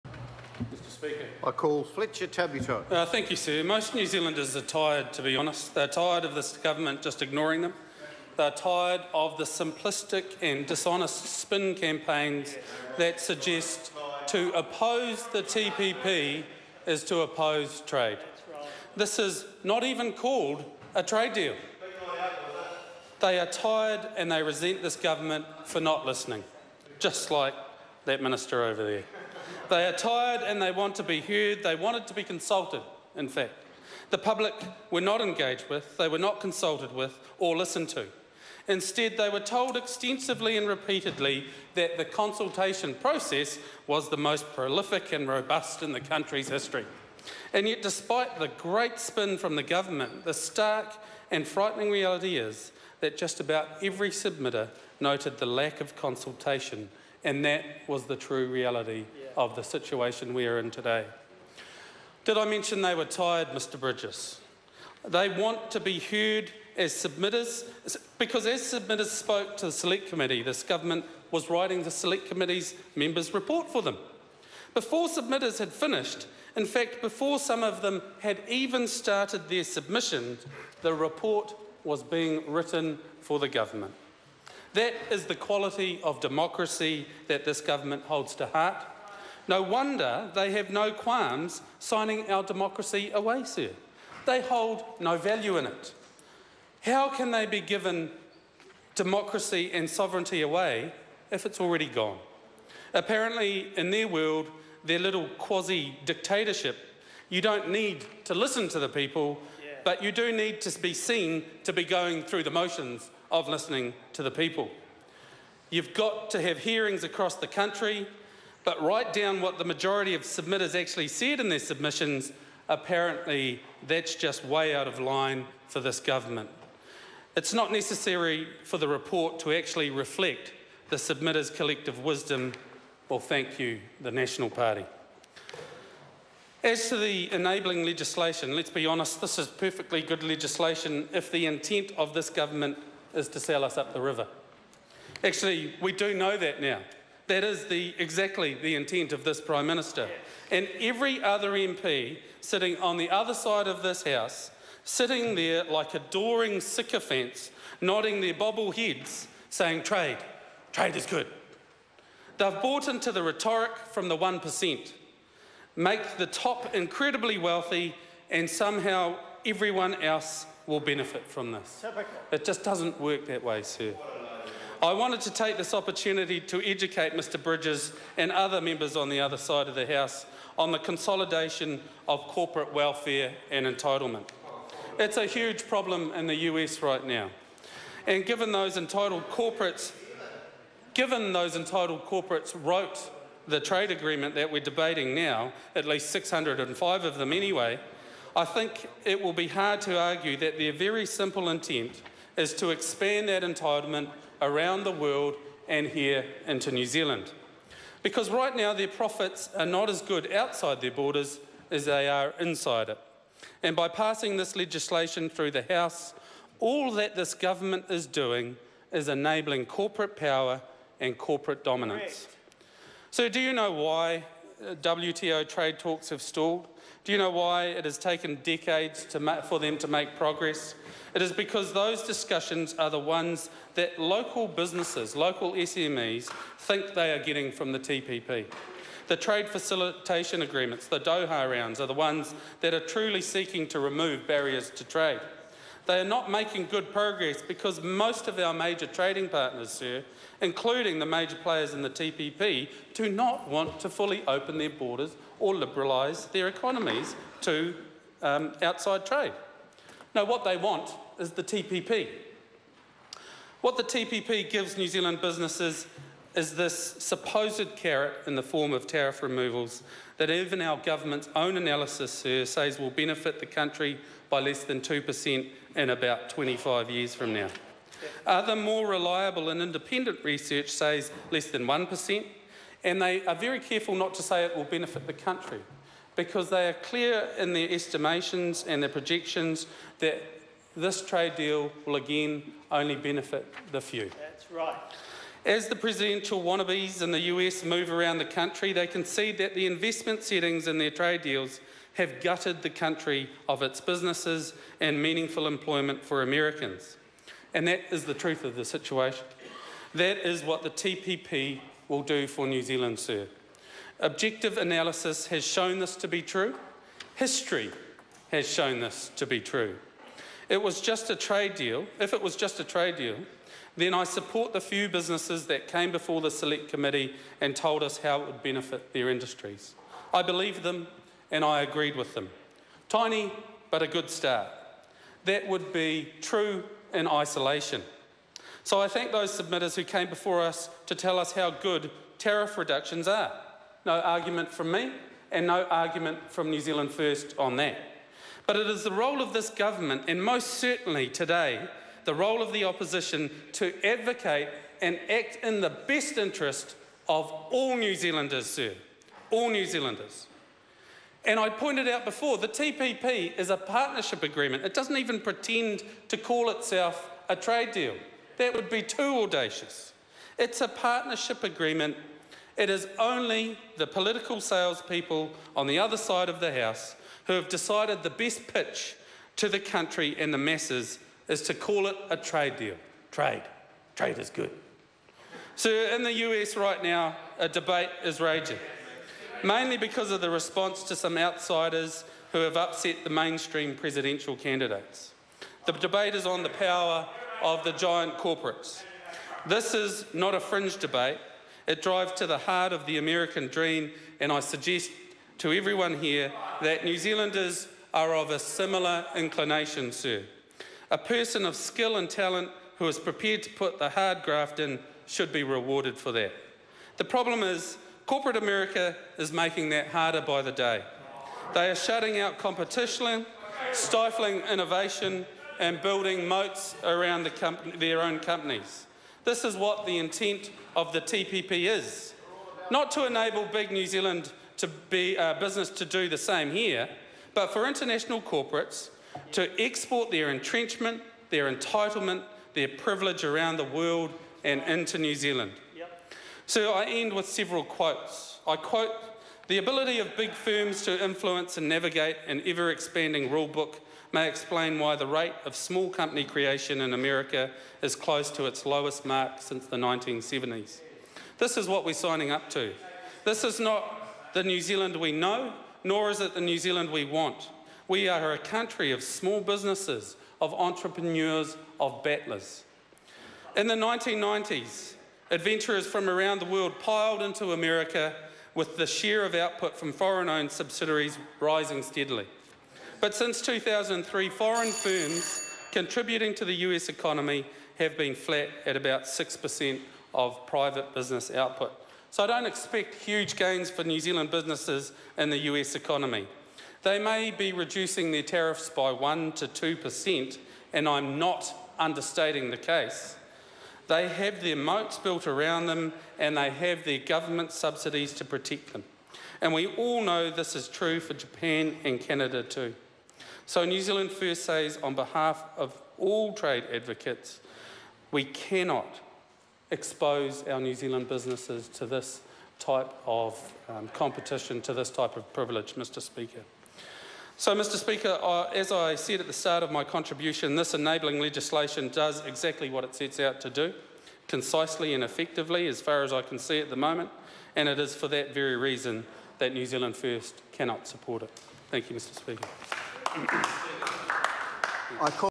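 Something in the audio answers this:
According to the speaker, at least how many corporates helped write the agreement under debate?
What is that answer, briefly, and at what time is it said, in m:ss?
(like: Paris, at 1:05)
605, at 3:16.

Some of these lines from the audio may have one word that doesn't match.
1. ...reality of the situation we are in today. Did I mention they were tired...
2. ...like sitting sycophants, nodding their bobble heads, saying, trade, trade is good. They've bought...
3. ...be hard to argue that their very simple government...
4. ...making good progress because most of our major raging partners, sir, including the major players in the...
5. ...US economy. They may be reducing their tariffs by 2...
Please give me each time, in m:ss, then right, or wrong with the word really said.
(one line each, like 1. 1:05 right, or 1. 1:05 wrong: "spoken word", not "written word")
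1. 0:58 right
2. 2:35 wrong: "adoring", not "sitting"
3. 3:19 wrong: "intent", not "government"
4. 4:06 wrong: "trading", not "raging"
5. 8:15 wrong: "1", not "2".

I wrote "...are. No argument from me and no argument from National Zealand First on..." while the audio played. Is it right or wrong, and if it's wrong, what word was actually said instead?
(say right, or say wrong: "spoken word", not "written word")
wrong: "New", not "National".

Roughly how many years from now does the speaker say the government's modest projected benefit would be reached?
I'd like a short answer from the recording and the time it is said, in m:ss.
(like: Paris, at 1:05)
25, at 4:36.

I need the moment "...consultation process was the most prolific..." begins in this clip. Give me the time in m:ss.
0:42.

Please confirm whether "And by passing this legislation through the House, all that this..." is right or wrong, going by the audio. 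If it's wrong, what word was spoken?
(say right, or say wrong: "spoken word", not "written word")
right.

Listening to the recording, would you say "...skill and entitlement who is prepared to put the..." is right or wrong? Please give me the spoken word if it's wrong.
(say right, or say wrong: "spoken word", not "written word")
wrong: "talent", not "entitlement".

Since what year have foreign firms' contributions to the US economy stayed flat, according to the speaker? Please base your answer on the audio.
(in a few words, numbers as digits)
2003.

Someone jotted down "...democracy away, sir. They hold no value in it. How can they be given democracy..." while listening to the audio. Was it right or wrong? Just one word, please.
right.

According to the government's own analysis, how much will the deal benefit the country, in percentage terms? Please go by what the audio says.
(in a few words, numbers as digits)
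less than 2%.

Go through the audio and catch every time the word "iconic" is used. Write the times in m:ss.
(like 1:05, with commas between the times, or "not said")
not said.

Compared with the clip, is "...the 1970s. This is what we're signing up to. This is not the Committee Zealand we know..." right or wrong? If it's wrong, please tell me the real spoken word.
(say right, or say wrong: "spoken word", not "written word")
wrong: "New", not "Committee".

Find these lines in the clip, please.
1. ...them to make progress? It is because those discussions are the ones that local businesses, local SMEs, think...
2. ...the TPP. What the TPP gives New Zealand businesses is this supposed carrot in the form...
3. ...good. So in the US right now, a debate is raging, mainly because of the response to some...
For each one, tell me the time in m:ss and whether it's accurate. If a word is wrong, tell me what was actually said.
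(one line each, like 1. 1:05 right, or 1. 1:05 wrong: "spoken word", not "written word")
1. 3:49 right
2. 4:21 right
3. 6:24 right.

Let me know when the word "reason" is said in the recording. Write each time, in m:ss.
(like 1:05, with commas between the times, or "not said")
8:58.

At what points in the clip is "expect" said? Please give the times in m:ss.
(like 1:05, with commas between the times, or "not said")
8:12.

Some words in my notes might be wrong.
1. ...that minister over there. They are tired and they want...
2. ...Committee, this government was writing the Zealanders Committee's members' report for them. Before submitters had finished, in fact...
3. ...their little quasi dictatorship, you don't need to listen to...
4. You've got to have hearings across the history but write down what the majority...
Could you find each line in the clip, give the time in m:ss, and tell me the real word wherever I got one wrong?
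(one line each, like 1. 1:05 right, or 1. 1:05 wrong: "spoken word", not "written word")
1. 0:28 right
2. 1:10 wrong: "Select", not "Zealanders"
3. 1:44 right
4. 1:55 wrong: "country", not "history".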